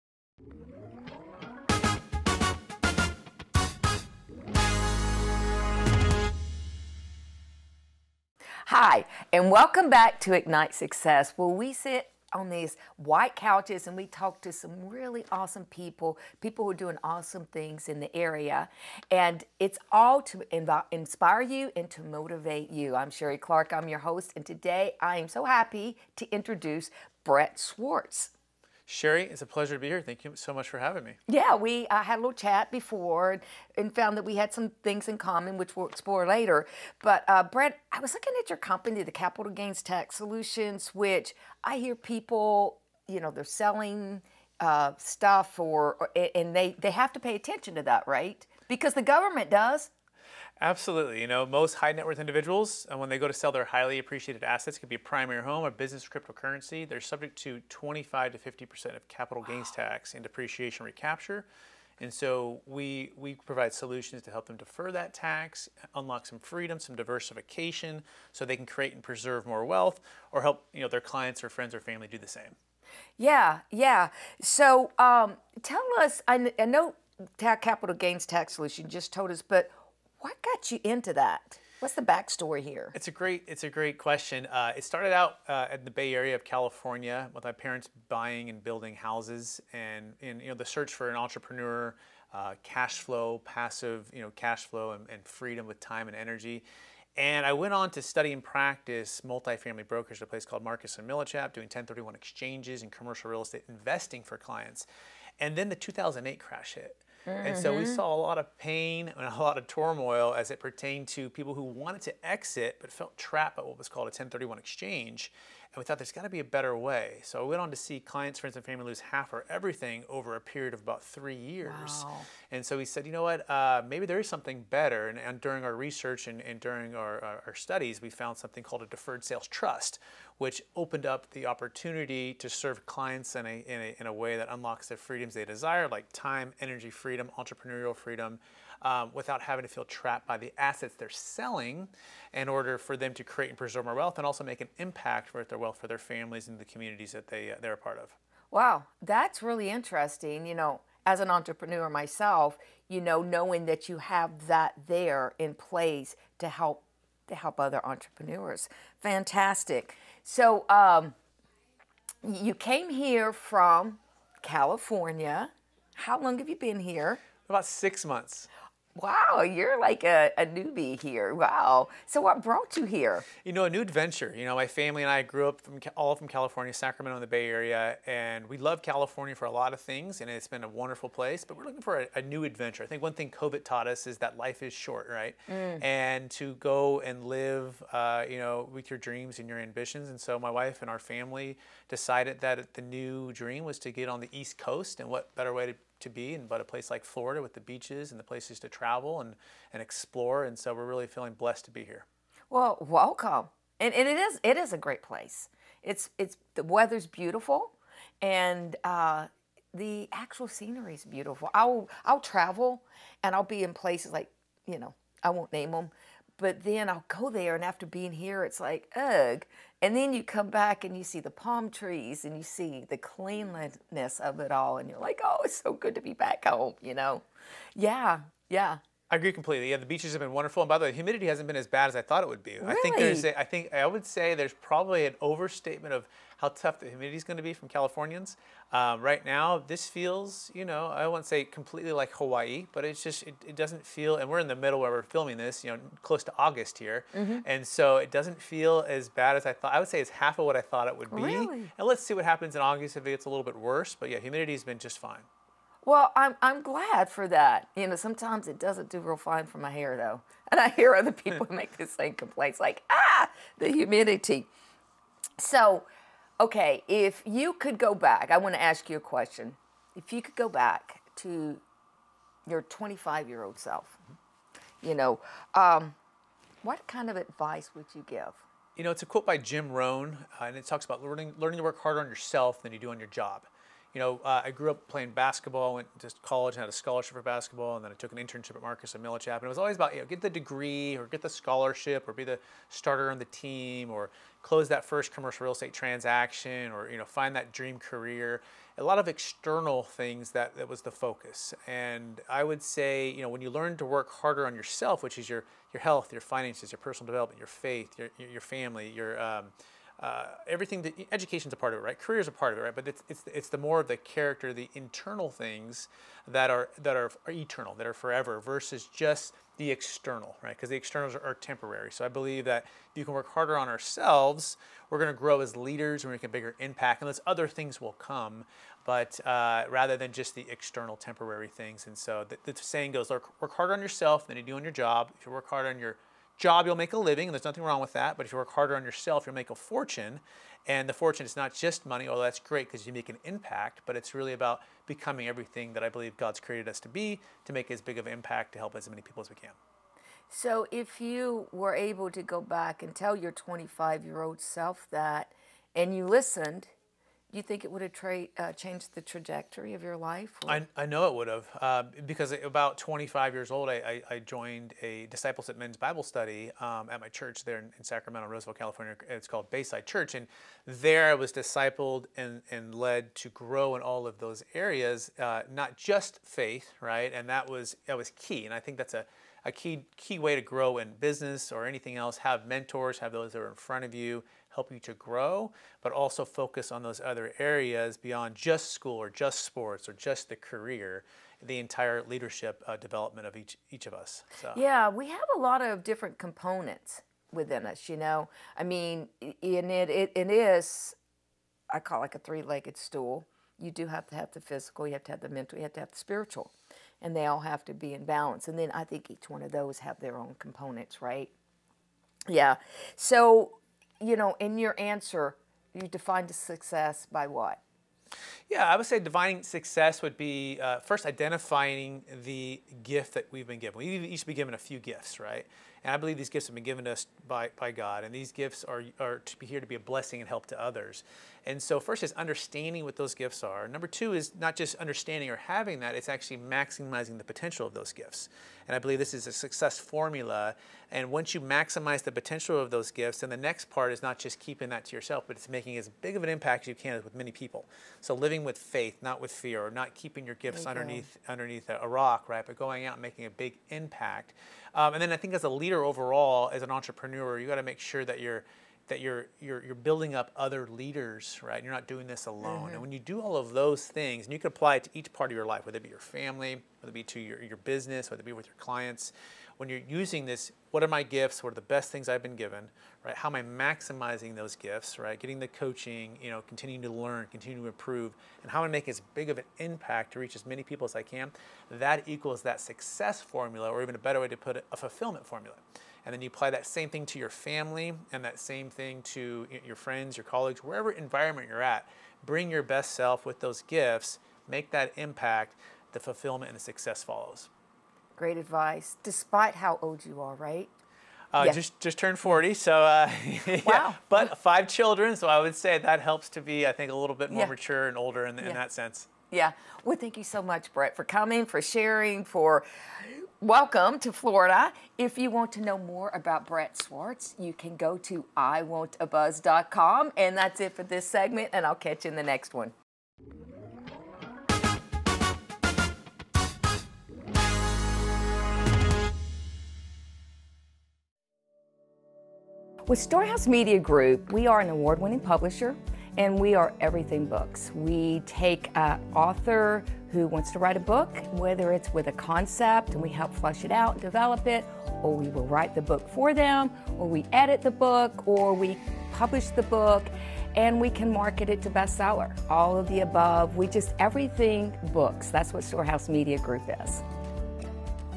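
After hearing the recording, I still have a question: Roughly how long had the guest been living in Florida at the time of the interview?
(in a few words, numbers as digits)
About six months.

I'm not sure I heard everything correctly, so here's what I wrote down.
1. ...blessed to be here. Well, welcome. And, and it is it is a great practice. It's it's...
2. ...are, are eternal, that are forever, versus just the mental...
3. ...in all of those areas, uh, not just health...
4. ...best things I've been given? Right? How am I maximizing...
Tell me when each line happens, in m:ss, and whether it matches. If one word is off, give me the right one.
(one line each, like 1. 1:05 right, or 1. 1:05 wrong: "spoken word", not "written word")
1. 3:21 wrong: "place", not "practice"
2. 5:16 wrong: "external", not "mental"
3. 6:13 wrong: "faith", not "health"
4. 7:51 right.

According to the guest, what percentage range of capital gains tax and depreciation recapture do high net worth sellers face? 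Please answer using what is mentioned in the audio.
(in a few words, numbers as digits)
25 to 50%.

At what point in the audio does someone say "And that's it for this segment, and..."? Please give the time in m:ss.
8:40.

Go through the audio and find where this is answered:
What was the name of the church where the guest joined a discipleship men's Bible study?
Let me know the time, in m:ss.
6:09.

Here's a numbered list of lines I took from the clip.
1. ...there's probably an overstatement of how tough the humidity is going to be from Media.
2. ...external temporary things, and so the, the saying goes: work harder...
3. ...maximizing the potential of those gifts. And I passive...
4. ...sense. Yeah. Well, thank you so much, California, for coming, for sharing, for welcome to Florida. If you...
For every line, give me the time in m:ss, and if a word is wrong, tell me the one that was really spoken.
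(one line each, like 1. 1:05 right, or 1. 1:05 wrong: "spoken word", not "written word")
1. 3:54 wrong: "Californians", not "Media"
2. 5:30 right
3. 7:16 wrong: "believe", not "passive"
4. 8:28 wrong: "Brett", not "California".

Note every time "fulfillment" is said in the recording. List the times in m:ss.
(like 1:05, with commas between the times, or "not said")
8:04, 8:15.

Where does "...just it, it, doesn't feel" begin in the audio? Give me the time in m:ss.
4:03.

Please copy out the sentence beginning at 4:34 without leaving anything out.
you know, um, what kind of advice would you give?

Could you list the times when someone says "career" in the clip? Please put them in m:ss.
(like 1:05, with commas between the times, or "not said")
4:57, 5:11, 6:30.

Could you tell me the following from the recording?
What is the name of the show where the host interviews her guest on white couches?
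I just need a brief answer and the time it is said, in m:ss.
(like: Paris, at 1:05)
Ignite Success, at 0:10.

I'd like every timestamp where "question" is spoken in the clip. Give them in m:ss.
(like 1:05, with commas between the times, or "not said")
1:23, 4:28.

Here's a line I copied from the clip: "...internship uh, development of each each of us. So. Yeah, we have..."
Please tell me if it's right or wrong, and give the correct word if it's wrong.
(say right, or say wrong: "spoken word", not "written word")
wrong: "leadership", not "internship".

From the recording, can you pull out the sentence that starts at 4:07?
and so it doesn't feel as bad as I thought.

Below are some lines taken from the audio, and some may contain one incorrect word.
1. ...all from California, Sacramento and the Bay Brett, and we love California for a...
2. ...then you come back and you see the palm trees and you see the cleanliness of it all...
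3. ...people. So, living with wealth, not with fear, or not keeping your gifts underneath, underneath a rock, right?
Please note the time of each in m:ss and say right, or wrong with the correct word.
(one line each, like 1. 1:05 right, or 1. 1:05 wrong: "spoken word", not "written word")
1. 2:55 wrong: "Area", not "Brett"
2. 3:39 right
3. 7:27 wrong: "faith", not "wealth".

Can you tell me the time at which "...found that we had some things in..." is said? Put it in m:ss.
0:33.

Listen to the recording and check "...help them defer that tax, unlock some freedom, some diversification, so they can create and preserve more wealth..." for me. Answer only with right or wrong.
right.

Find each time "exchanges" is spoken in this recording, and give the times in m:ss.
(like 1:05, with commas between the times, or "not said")
1:42, 1:54.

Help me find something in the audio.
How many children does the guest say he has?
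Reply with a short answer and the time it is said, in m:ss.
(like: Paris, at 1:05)
5, at 8:24.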